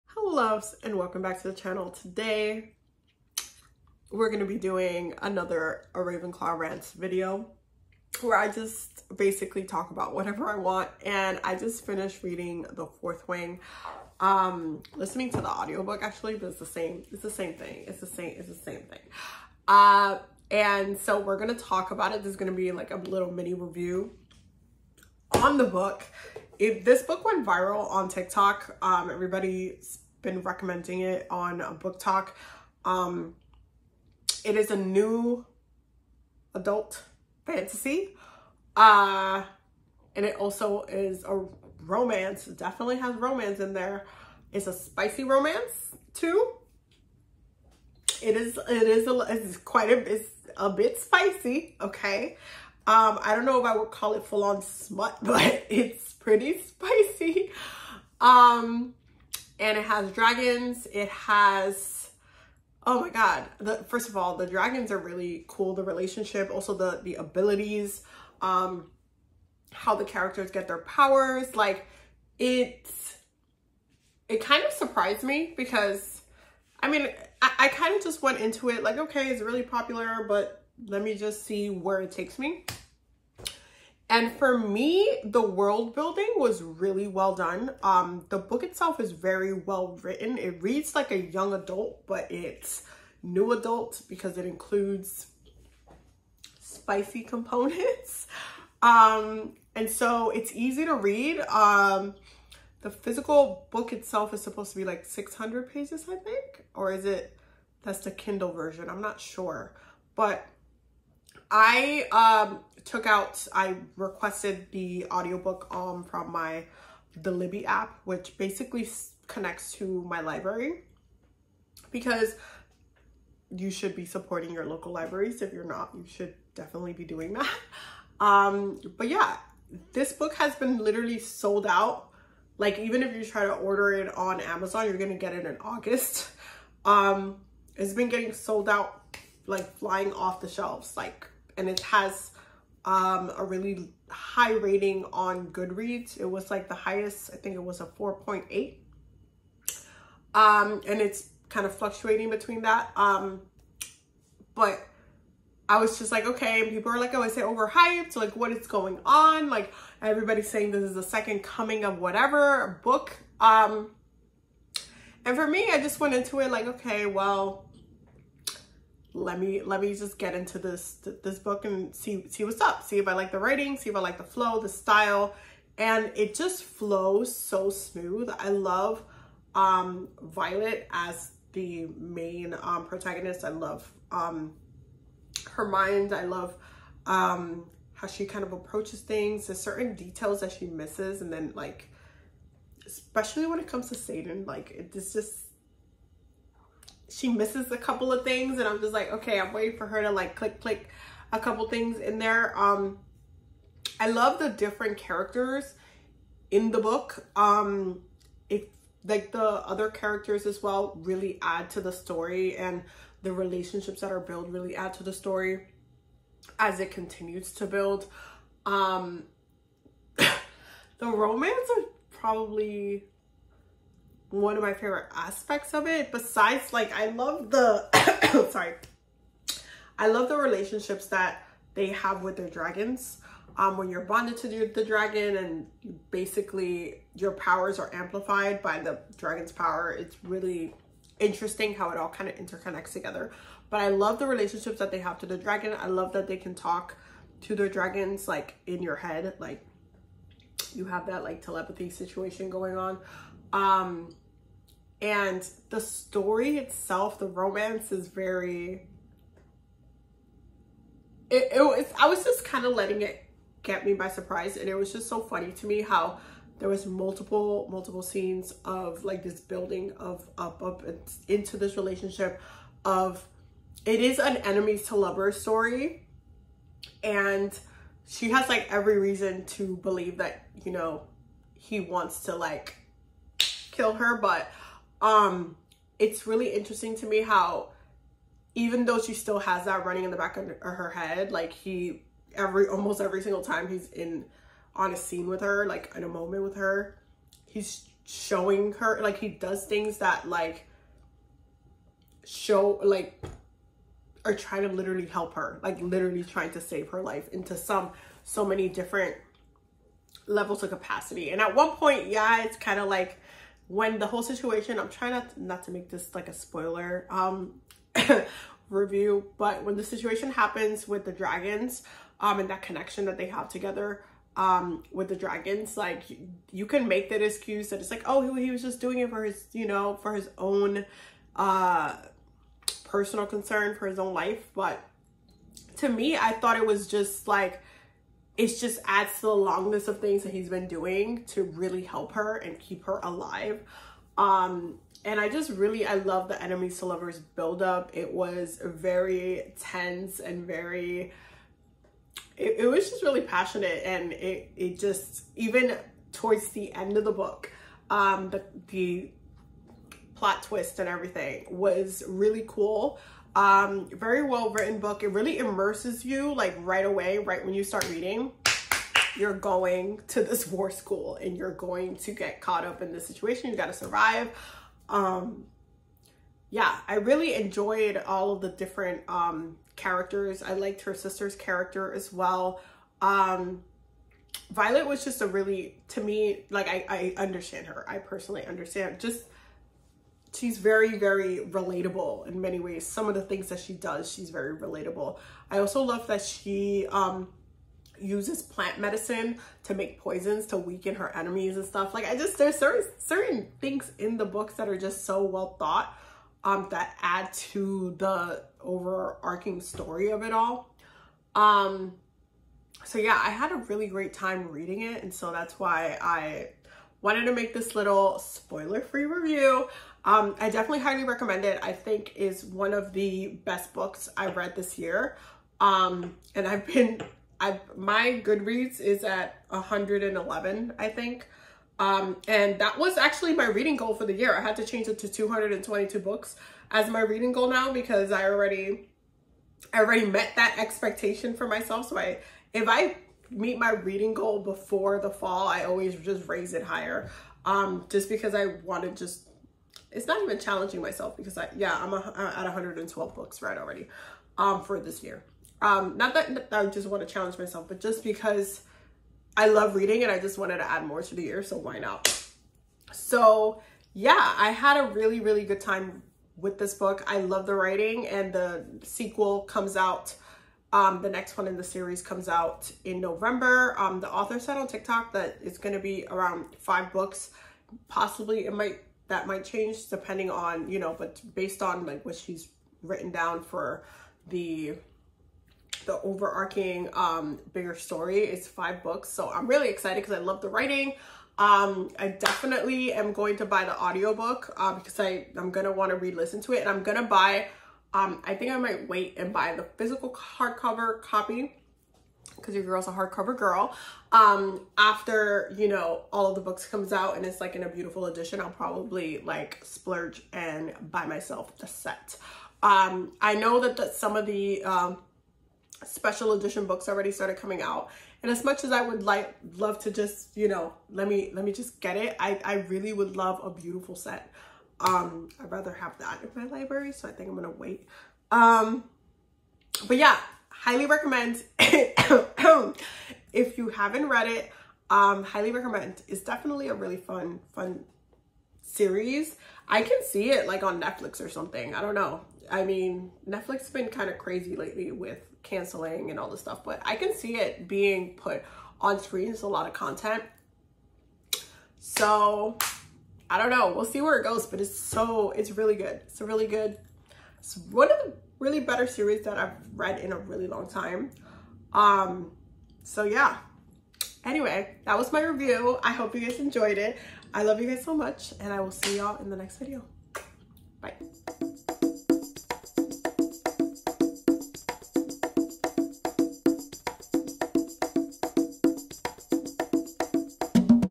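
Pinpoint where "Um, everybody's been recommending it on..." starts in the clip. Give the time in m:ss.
0:28.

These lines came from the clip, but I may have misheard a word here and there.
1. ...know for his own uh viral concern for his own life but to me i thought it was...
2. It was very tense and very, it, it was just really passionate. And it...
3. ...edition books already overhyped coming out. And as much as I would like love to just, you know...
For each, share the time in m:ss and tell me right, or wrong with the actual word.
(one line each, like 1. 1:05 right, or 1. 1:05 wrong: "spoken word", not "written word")
1. 5:29 wrong: "personal", not "viral"
2. 5:47 right
3. 8:36 wrong: "started", not "overhyped".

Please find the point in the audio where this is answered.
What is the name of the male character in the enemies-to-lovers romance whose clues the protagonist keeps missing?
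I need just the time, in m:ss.
3:13.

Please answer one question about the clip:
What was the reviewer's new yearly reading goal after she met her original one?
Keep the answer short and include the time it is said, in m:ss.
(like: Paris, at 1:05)
222 books, at 7:15.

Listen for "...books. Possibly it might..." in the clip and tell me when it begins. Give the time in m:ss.
7:56.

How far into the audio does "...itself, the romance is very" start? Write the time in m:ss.
4:16.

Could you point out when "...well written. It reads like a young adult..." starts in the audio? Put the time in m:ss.
1:29.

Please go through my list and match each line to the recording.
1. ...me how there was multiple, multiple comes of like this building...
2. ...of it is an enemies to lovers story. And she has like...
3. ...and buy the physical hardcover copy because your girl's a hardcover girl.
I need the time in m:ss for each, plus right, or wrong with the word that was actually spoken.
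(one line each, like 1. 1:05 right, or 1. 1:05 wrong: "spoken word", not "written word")
1. 4:25 wrong: "scenes", not "comes"
2. 4:32 right
3. 8:19 right.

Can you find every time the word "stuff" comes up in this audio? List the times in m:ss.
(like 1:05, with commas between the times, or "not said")
6:41, 9:06.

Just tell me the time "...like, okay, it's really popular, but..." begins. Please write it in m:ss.
1:18.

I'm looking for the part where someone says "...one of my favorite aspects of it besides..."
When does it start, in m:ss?
3:44.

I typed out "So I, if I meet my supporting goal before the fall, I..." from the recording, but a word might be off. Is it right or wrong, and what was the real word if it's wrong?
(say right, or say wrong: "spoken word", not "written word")
wrong: "reading", not "supporting".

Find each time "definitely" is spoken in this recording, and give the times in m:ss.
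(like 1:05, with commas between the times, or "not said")
0:42, 2:06, 7:00, 8:12, 8:56.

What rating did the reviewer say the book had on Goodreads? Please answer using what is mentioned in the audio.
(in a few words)
4.8.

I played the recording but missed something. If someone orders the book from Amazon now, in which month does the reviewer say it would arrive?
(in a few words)
August.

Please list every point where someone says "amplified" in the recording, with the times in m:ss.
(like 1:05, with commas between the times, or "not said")
3:57.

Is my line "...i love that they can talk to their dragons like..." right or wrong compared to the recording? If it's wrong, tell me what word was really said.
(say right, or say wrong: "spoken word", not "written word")
right.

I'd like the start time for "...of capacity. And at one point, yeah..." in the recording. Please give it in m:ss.
5:10.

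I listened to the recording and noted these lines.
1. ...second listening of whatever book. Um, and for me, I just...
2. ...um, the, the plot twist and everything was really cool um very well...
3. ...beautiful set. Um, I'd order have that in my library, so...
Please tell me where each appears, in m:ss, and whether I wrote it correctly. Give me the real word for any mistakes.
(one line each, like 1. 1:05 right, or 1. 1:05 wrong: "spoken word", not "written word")
1. 2:41 wrong: "coming", not "listening"
2. 5:57 right
3. 8:43 wrong: "rather", not "order".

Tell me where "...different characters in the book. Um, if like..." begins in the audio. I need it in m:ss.
3:24.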